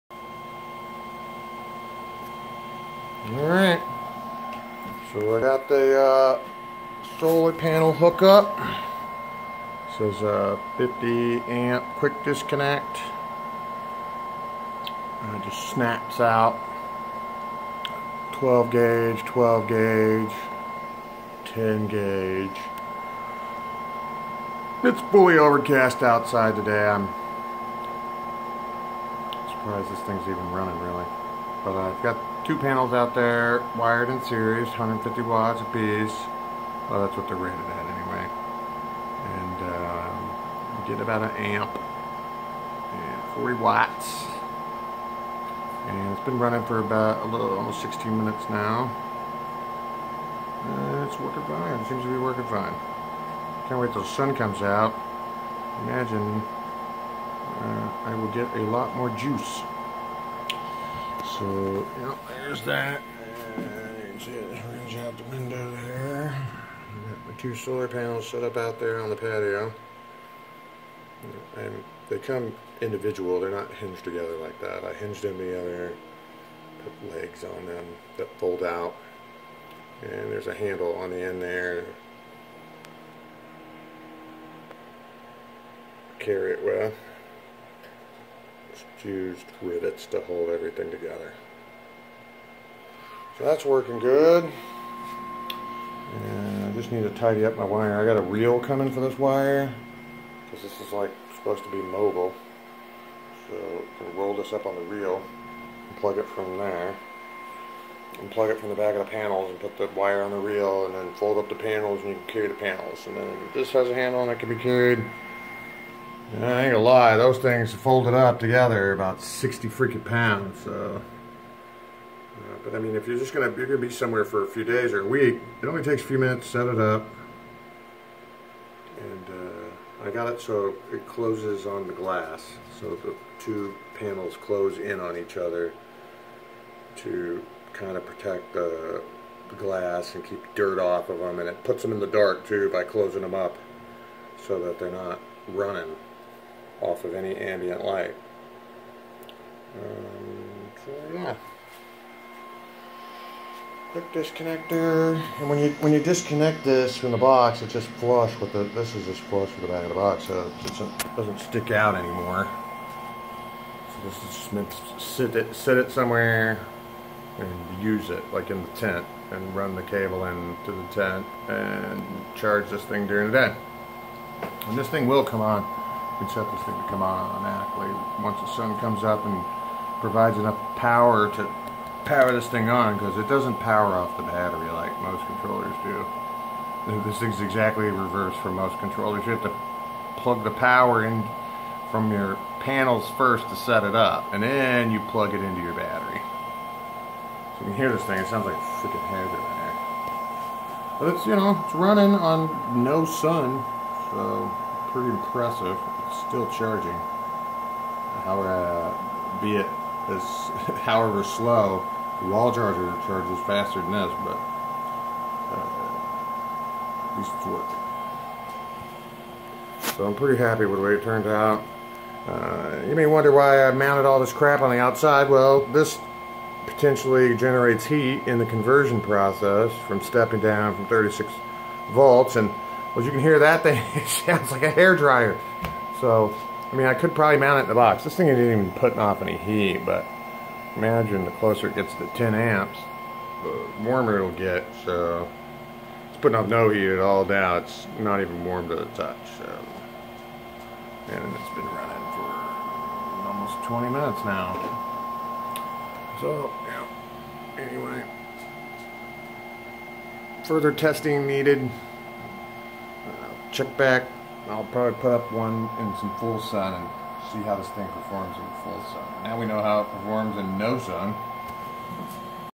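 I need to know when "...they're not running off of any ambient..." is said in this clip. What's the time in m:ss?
2:24.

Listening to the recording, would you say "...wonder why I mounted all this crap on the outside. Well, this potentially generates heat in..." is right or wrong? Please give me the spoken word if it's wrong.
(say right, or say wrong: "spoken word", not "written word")
right.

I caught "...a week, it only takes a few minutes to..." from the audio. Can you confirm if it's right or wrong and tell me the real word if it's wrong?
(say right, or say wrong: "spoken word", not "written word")
right.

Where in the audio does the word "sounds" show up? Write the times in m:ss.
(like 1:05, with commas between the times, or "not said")
3:18, 3:54.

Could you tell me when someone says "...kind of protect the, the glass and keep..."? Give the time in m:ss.
2:17.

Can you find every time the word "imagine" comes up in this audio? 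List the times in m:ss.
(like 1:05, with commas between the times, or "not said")
0:55, 4:00.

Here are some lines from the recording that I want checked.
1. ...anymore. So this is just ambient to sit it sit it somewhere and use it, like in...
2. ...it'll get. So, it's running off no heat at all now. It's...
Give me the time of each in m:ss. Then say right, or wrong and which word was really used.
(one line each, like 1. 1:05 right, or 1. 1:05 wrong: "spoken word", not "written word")
1. 2:41 wrong: "meant", not "ambient"
2. 4:04 wrong: "putting", not "running".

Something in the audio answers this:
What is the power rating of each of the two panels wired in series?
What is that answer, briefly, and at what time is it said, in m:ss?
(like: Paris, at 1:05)
150 watts, at 0:34.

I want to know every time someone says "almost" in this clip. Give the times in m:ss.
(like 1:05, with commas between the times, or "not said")
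0:47, 4:13.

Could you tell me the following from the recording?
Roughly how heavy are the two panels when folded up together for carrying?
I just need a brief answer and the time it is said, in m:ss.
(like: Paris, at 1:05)
60 pounds, at 1:59.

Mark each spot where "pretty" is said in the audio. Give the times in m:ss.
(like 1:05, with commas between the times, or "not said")
3:24, 3:40.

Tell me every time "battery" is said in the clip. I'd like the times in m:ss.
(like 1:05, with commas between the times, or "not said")
3:04, 3:15.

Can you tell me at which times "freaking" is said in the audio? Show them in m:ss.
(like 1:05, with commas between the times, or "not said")
1:59, 3:18.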